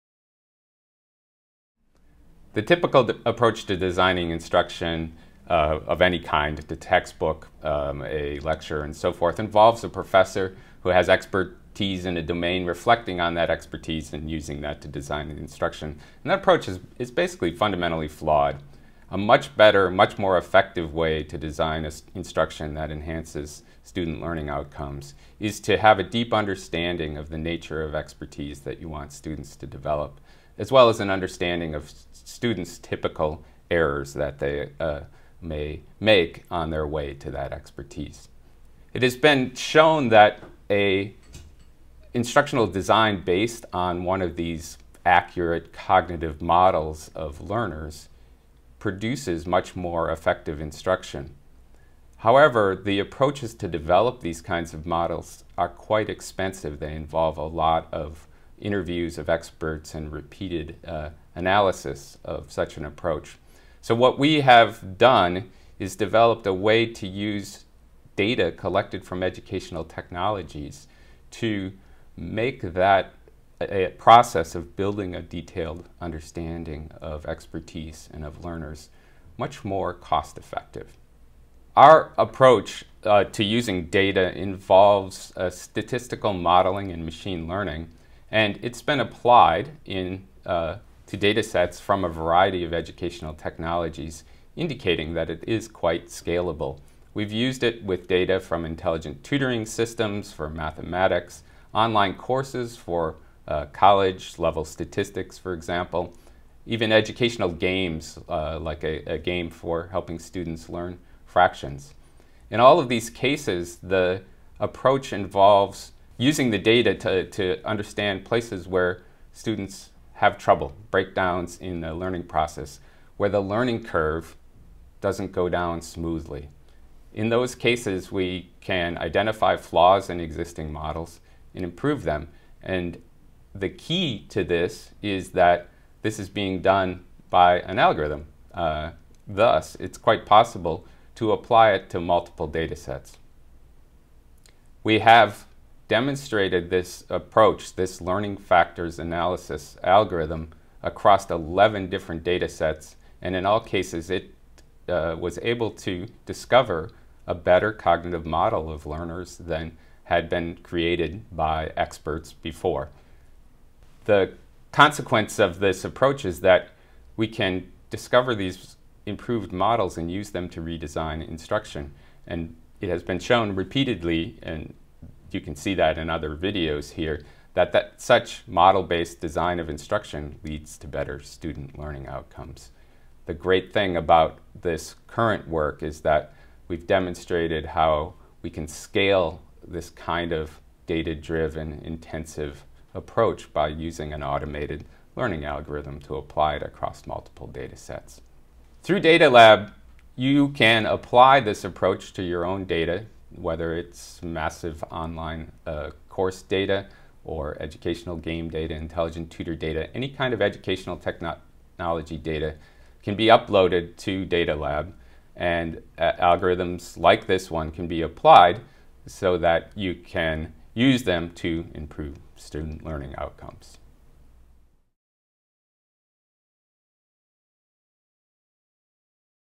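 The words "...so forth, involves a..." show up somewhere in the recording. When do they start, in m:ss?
0:08.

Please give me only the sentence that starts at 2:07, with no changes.
In those cases, we can identify flaws in existing models and improve them.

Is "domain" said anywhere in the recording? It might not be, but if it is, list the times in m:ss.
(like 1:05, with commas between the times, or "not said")
0:12.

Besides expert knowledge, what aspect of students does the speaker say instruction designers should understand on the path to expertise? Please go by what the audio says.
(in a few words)
typical errors.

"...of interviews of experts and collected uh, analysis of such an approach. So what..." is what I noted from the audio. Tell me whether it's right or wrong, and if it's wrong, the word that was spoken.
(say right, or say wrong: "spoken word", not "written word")
wrong: "repeated", not "collected".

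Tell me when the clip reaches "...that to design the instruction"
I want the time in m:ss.
0:14.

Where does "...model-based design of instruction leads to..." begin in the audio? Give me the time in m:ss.
2:58.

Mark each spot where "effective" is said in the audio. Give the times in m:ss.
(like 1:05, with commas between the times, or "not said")
0:20, 0:50, 1:20.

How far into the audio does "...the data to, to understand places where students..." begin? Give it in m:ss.
1:56.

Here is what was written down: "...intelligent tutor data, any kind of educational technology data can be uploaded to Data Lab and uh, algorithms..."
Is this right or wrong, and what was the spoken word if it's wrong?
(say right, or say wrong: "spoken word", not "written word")
right.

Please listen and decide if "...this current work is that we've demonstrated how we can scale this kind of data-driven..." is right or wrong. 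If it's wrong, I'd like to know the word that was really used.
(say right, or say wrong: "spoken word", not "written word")
right.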